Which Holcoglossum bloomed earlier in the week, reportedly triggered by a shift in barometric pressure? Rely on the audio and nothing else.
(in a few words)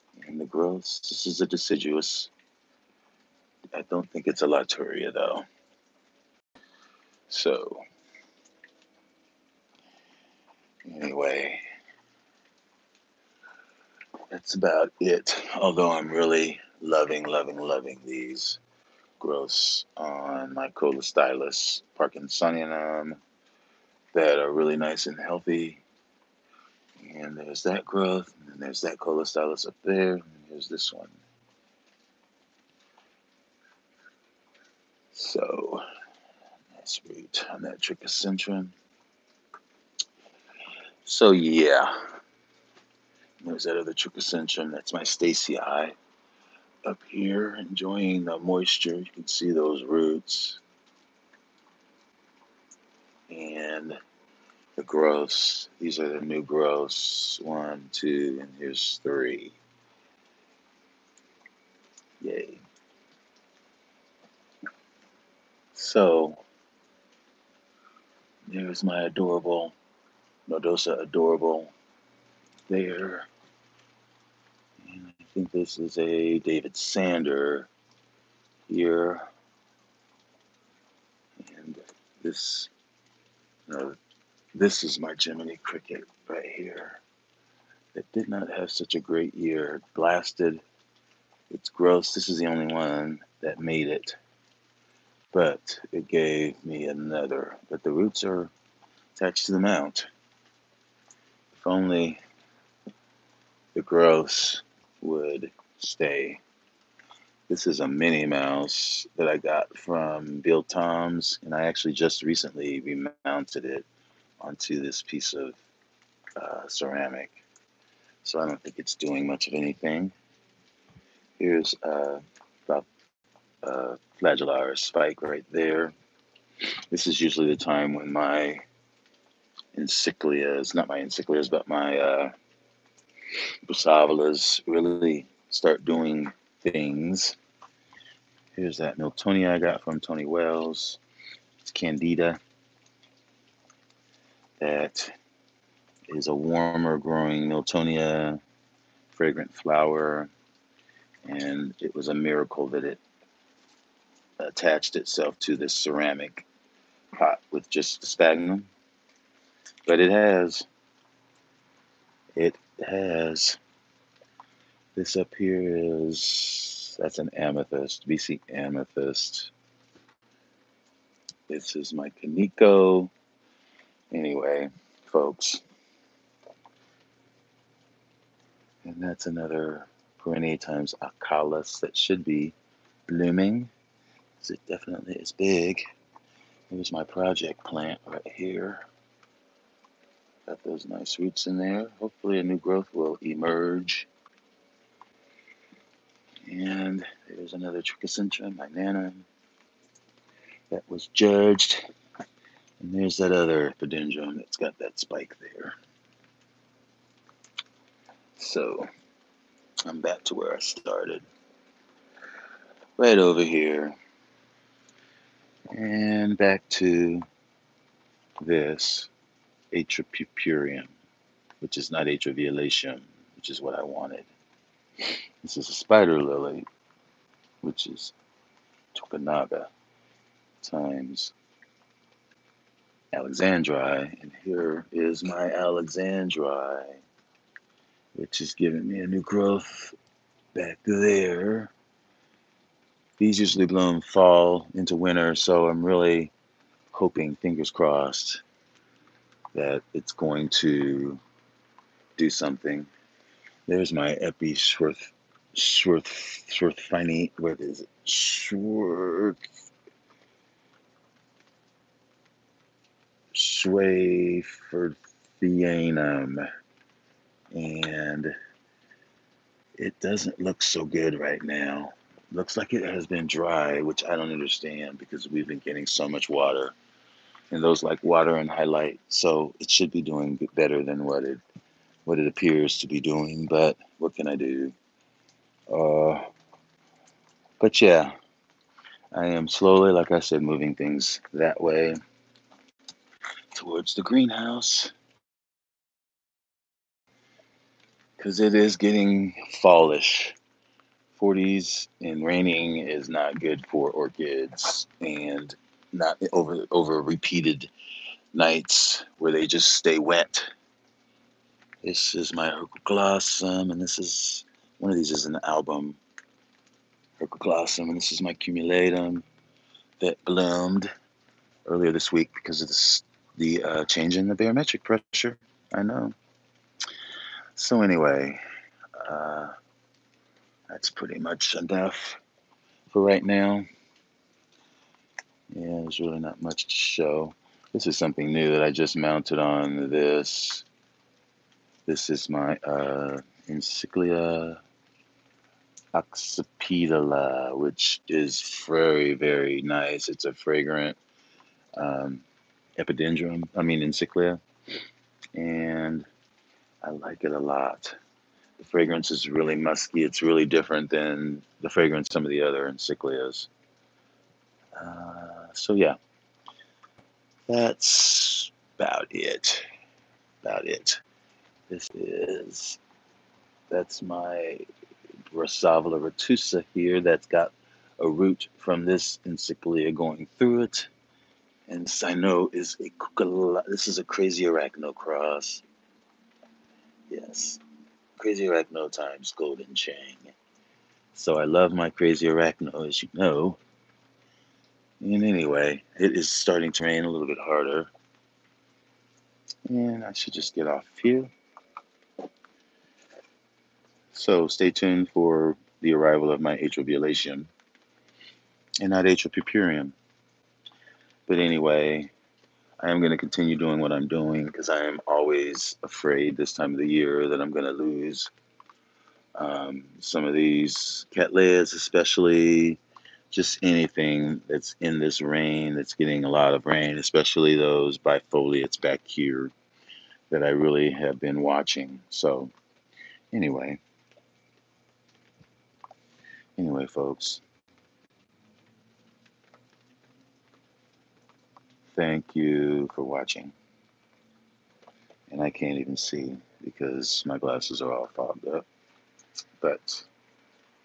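Cumulatum.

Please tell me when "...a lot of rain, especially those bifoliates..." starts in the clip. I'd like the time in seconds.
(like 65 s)
426 s.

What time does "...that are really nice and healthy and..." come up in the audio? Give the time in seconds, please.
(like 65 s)
24 s.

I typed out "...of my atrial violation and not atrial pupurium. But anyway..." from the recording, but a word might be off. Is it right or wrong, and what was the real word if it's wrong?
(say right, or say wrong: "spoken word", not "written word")
right.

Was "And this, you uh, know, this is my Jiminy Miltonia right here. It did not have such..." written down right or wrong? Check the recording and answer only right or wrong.
wrong.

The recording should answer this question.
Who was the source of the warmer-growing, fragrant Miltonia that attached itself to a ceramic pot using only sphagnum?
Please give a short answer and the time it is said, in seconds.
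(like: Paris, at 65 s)
Tony Wells, at 140 s.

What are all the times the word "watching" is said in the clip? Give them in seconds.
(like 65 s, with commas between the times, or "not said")
431 s, 443 s.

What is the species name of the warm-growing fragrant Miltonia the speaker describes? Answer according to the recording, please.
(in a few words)
Candida.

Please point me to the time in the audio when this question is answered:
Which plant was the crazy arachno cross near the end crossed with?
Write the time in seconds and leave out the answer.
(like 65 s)
389 s.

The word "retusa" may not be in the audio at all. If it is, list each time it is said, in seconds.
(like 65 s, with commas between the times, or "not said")
376 s.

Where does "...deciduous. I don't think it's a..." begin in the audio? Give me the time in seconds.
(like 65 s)
1 s.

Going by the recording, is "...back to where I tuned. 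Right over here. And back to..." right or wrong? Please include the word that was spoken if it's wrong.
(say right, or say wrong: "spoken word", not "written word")
wrong: "started", not "tuned".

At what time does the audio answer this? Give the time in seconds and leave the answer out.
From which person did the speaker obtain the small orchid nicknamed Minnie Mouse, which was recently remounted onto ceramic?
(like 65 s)
110 s.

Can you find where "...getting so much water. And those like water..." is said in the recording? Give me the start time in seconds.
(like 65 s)
275 s.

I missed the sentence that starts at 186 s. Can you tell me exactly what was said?
Here's my project plant right here.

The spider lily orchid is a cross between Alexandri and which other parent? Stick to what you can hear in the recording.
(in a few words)
Tokunaga.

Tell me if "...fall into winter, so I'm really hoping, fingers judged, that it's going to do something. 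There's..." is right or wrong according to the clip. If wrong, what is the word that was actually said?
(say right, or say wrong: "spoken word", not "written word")
wrong: "crossed", not "judged".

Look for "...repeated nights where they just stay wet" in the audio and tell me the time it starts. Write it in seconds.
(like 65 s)
307 s.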